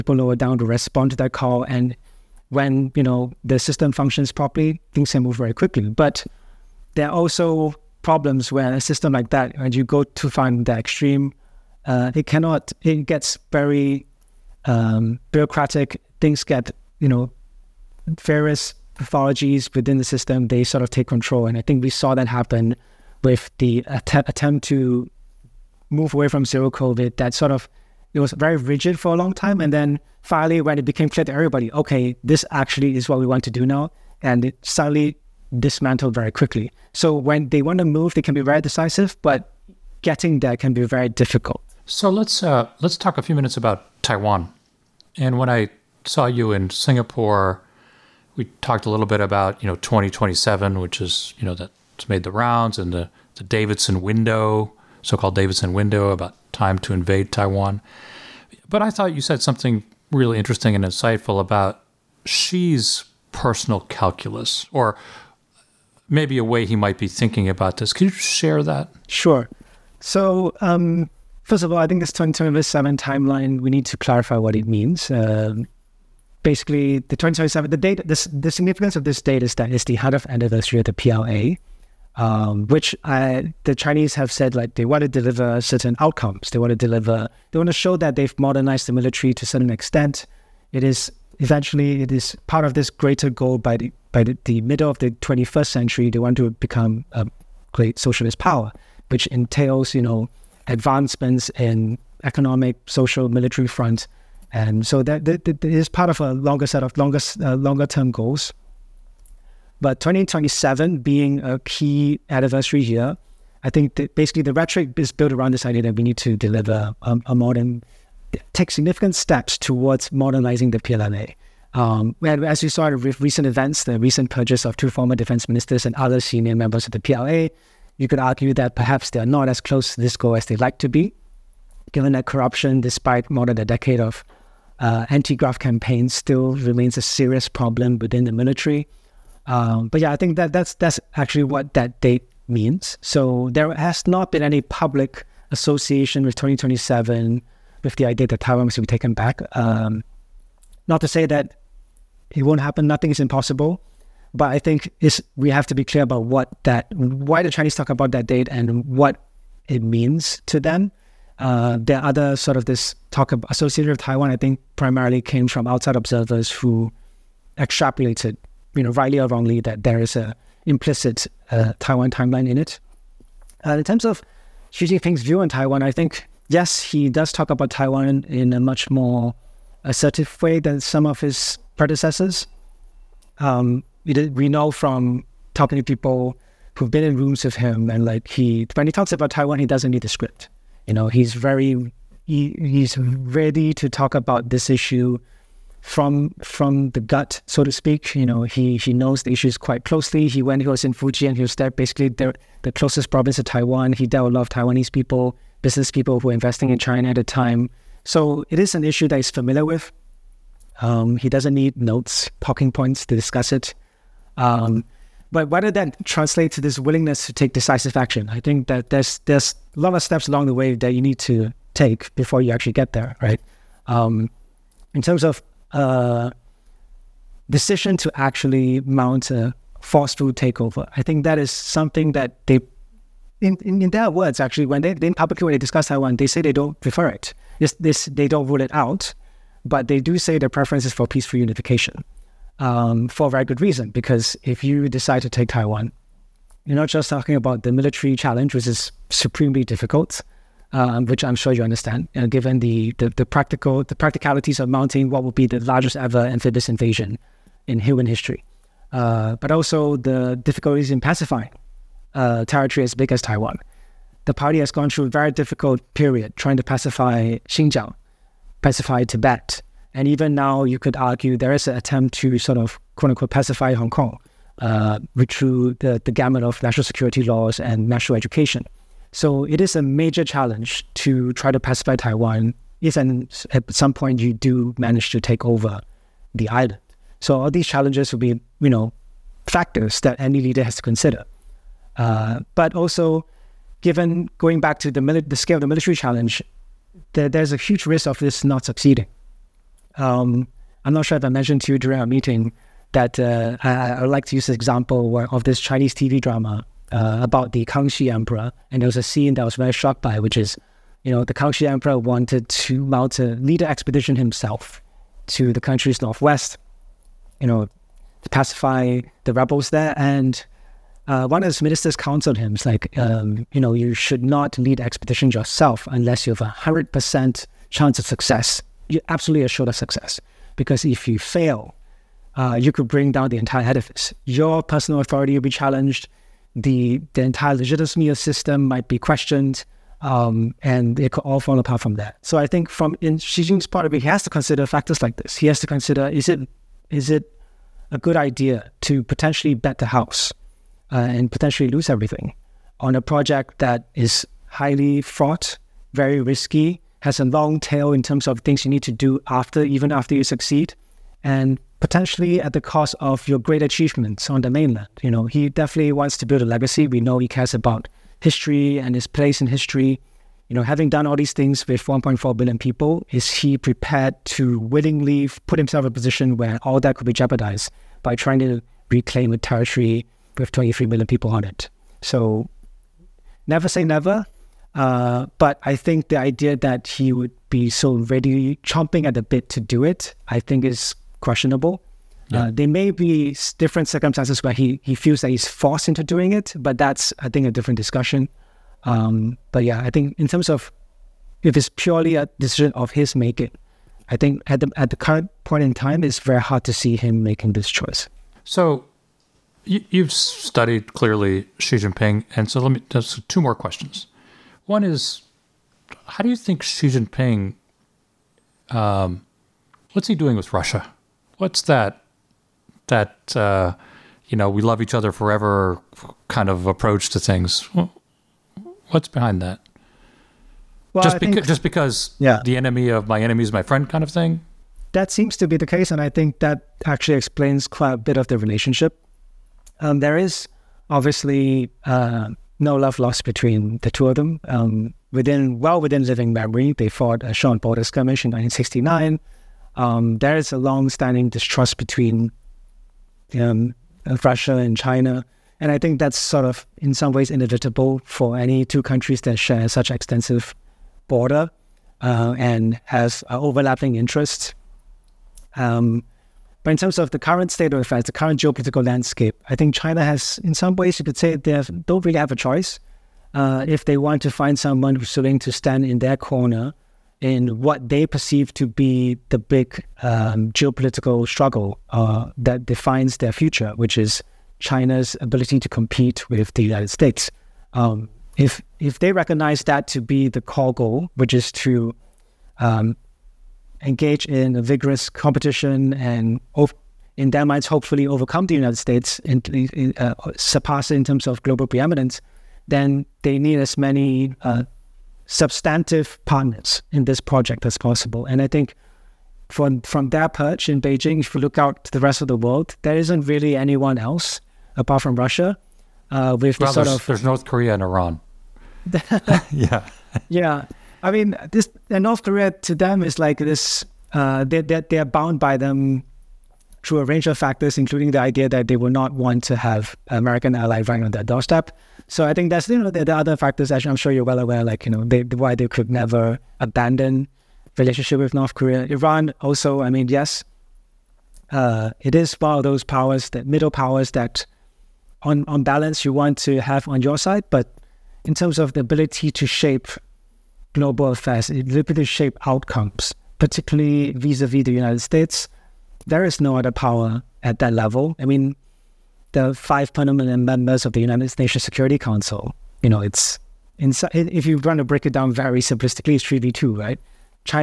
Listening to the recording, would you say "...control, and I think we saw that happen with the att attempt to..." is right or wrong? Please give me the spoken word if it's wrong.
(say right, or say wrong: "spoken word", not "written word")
right.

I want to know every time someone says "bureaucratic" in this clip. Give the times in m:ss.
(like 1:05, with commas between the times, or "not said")
0:15.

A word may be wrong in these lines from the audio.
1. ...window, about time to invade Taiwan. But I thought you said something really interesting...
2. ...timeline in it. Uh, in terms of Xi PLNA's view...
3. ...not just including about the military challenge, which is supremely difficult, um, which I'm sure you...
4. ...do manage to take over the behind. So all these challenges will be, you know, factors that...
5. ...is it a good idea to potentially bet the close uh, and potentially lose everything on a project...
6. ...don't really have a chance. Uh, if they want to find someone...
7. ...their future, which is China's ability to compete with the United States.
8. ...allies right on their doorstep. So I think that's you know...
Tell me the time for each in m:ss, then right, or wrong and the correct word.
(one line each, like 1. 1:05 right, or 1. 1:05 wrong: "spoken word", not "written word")
1. 0:55 right
2. 2:52 wrong: "Jinping", not "PLNA"
3. 4:06 wrong: "talking", not "including"
4. 4:44 wrong: "island", not "behind"
5. 5:46 wrong: "house", not "close"
6. 7:51 wrong: "choice", not "chance"
7. 8:03 right
8. 8:50 right.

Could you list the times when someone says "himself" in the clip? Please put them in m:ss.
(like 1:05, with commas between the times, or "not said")
5:14, 6:15.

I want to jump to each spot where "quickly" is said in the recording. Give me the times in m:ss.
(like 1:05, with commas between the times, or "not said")
0:05, 0:36.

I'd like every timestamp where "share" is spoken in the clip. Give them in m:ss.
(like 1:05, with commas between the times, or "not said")
1:08, 7:39.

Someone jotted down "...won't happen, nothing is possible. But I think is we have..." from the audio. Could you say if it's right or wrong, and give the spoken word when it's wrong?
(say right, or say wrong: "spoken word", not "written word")
wrong: "impossible", not "possible".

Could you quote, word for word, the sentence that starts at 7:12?
the enemy of my enemy is my friend kind of thing?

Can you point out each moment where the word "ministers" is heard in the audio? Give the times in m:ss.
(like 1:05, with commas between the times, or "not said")
2:05, 5:21.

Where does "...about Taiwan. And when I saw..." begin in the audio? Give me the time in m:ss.
0:43.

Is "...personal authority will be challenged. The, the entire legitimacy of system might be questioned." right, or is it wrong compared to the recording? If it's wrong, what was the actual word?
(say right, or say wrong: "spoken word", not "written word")
right.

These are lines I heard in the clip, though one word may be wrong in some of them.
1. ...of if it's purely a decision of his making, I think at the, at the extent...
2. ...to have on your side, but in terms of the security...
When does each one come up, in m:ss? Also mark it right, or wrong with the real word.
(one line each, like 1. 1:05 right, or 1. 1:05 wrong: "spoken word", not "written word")
1. 6:40 wrong: "current", not "extent"
2. 9:06 wrong: "ability", not "security".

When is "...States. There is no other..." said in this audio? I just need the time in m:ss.
9:15.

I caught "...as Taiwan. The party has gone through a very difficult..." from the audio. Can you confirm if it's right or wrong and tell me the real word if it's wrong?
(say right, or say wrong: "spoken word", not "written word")
right.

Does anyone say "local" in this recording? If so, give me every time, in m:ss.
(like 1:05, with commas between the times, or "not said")
not said.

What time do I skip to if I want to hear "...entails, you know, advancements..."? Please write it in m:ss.
1:39.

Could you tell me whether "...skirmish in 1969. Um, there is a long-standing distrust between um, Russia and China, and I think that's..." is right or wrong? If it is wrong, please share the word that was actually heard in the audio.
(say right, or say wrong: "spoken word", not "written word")
right.